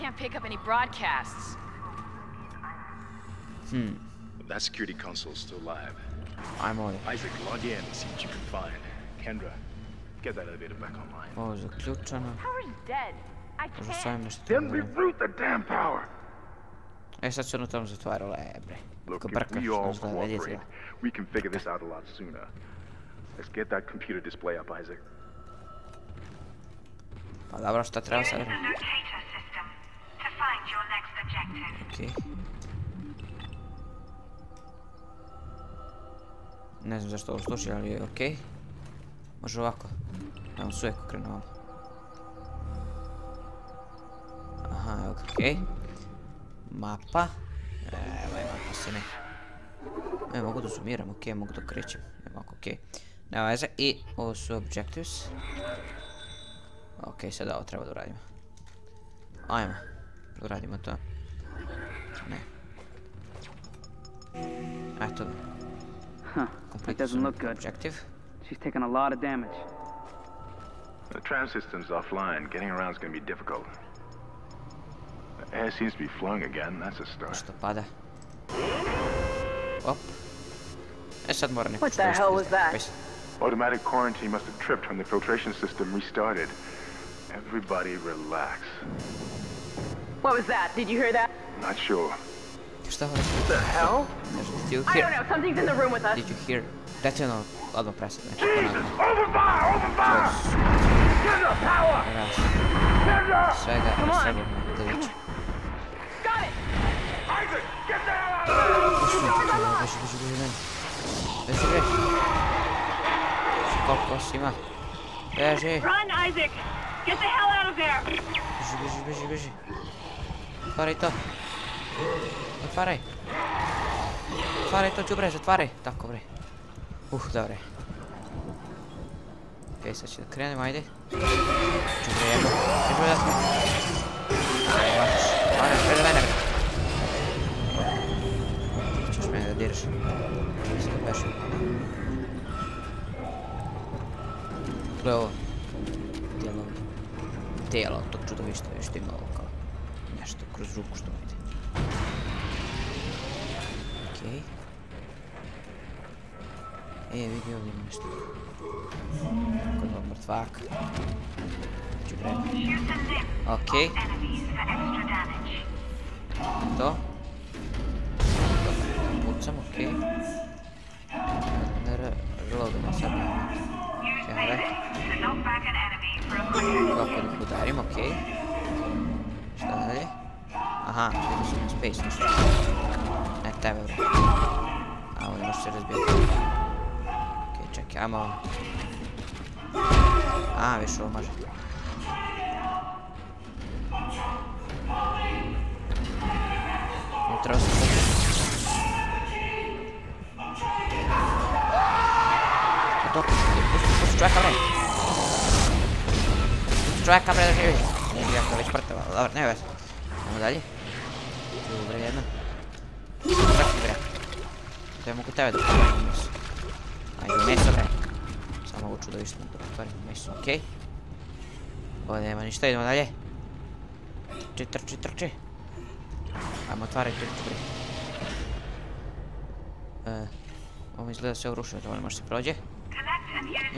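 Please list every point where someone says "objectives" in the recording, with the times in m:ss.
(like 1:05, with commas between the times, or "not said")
0:54, 1:07.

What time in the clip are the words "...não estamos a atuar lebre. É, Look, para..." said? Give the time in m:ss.
0:17.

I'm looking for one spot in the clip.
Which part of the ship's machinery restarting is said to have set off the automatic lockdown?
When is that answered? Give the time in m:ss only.
1:25.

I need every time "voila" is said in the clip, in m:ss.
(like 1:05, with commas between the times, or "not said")
not said.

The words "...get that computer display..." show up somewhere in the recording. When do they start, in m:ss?
0:23.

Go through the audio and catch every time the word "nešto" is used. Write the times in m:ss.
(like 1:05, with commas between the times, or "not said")
2:30, 2:37.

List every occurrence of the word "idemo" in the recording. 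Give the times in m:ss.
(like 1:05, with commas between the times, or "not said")
3:29, 3:42.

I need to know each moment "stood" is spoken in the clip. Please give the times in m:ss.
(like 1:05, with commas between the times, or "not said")
not said.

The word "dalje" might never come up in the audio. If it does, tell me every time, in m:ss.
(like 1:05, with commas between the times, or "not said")
3:30, 3:42.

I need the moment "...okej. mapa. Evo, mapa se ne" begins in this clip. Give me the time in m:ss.
0:45.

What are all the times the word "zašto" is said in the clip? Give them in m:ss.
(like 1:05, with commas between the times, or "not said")
0:37.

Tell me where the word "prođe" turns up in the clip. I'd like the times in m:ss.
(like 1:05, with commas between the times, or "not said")
3:52.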